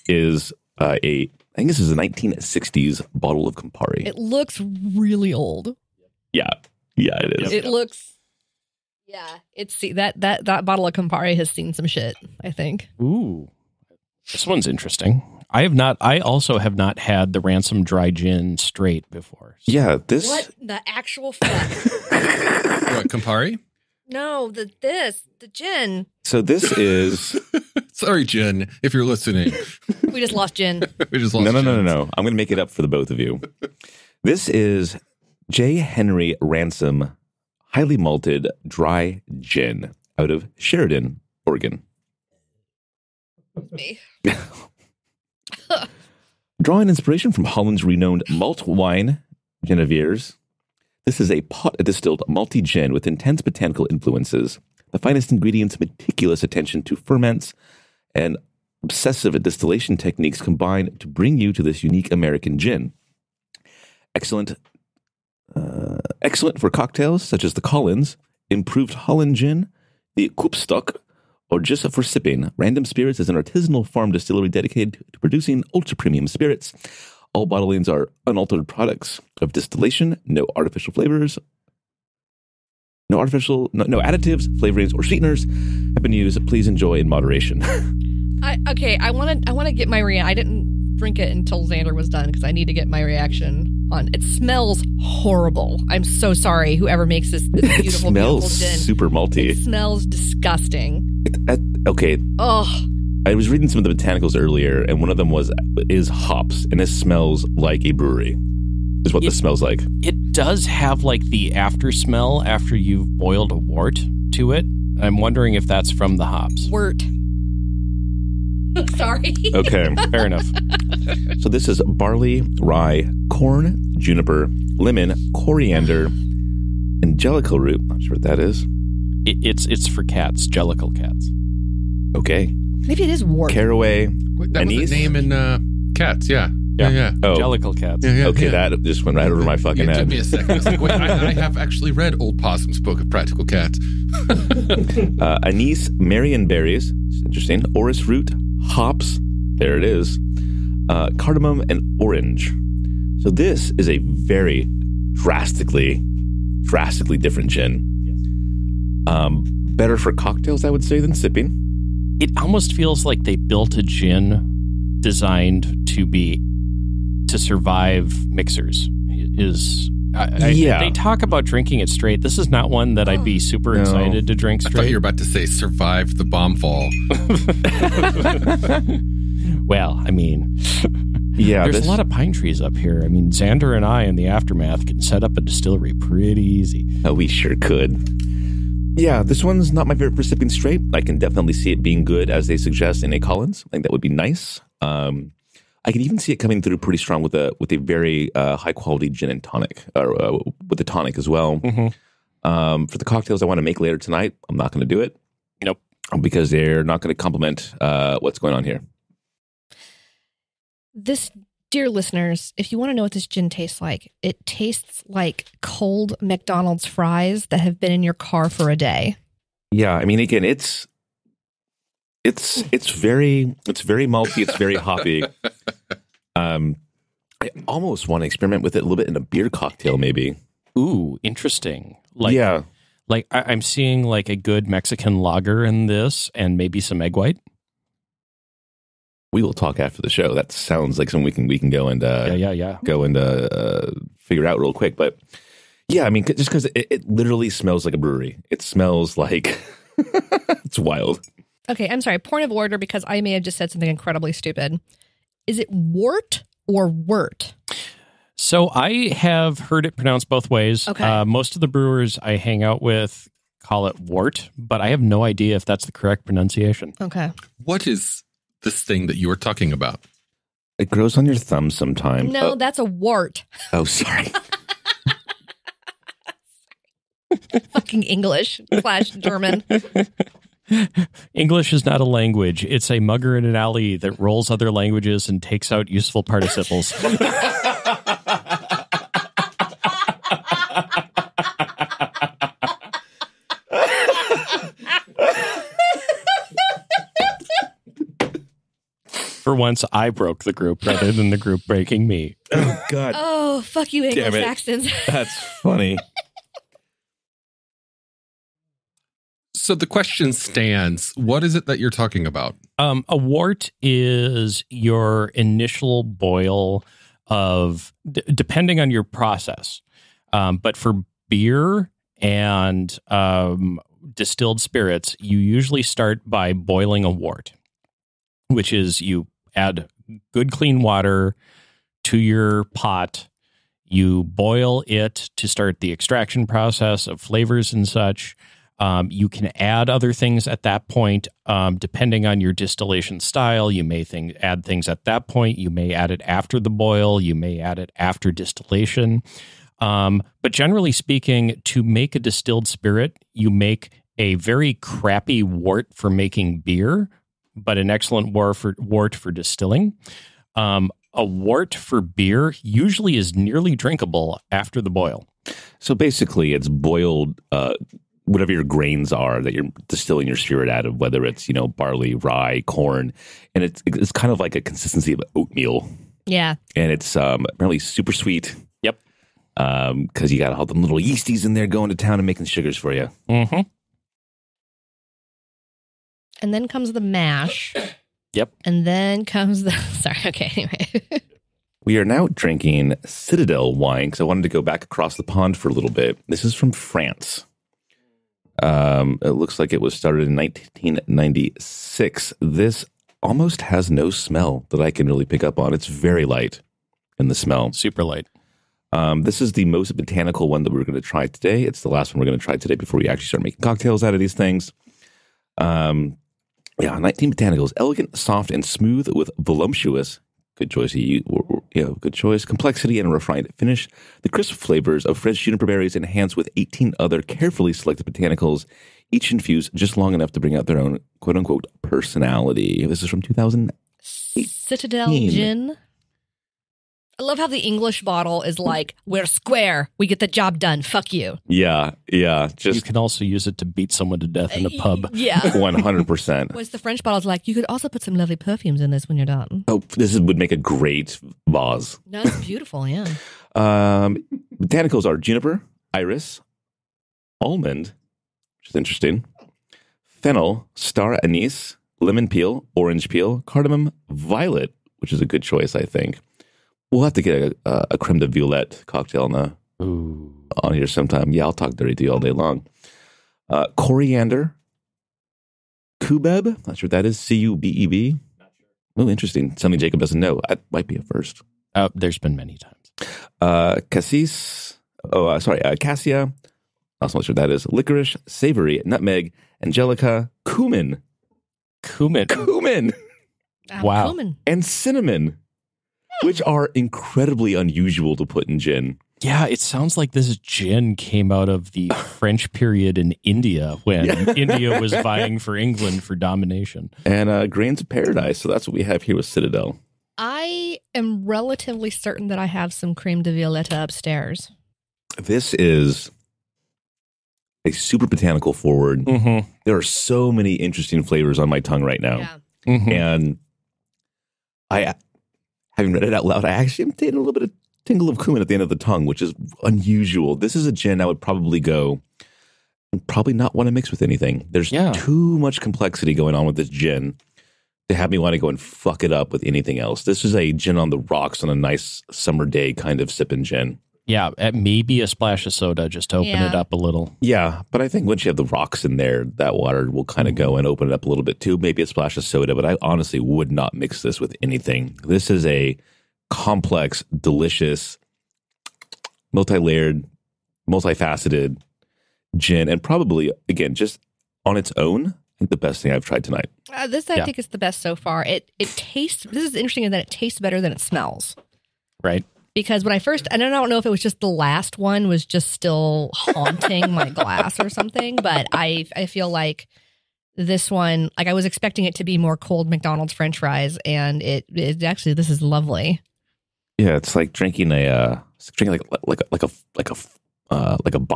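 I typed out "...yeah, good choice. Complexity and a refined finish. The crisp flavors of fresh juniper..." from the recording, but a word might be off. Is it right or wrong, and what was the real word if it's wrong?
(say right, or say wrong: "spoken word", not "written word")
right.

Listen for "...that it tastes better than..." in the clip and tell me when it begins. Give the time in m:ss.
9:29.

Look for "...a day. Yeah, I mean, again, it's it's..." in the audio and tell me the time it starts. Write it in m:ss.
3:38.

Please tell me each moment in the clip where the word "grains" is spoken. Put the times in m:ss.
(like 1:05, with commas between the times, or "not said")
6:08, 8:27.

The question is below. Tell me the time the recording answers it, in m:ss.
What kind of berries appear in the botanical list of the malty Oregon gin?
2:25.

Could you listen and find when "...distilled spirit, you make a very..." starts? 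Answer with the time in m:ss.
5:52.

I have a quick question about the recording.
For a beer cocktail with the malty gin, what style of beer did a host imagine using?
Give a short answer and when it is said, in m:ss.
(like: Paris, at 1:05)
Mexican lager, at 3:54.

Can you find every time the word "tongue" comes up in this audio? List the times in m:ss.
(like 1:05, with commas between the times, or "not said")
8:41, 8:48.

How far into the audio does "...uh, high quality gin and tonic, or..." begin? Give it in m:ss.
3:18.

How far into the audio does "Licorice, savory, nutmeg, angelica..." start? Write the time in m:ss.
8:07.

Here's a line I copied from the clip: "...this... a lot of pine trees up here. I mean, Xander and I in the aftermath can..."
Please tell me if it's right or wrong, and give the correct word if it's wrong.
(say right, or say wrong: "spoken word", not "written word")
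right.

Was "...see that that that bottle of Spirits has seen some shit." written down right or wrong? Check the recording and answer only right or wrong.
wrong.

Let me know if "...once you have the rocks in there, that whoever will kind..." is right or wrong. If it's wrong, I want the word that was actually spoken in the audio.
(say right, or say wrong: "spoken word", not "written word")
wrong: "water", not "whoever".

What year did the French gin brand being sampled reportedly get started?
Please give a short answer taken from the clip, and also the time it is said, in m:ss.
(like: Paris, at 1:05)
1996, at 6:40.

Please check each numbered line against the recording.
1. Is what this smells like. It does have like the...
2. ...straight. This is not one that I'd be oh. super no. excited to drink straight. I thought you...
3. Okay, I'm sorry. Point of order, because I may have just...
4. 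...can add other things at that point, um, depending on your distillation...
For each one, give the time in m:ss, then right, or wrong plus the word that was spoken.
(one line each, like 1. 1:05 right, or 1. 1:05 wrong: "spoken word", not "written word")
1. 1:49 right
2. 2:51 right
3. 4:11 right
4. 5:39 right.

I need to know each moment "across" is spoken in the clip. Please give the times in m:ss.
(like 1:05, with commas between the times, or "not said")
6:34.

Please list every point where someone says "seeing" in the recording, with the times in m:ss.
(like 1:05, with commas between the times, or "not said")
3:53.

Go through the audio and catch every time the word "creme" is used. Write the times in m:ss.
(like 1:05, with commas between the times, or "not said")
7:47, 8:32.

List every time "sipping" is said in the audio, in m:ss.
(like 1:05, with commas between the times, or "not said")
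1:12, 2:41, 3:10, 9:03.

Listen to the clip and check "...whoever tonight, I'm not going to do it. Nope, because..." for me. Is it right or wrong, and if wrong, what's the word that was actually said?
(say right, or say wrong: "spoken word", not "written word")
wrong: "later", not "whoever".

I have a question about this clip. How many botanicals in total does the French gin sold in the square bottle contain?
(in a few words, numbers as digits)
19.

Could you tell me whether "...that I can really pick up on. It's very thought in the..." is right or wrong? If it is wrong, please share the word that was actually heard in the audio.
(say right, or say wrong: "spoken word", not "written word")
wrong: "light", not "thought".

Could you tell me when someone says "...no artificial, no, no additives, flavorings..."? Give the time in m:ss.
1:23.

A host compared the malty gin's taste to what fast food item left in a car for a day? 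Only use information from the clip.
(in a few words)
McDonald's fries.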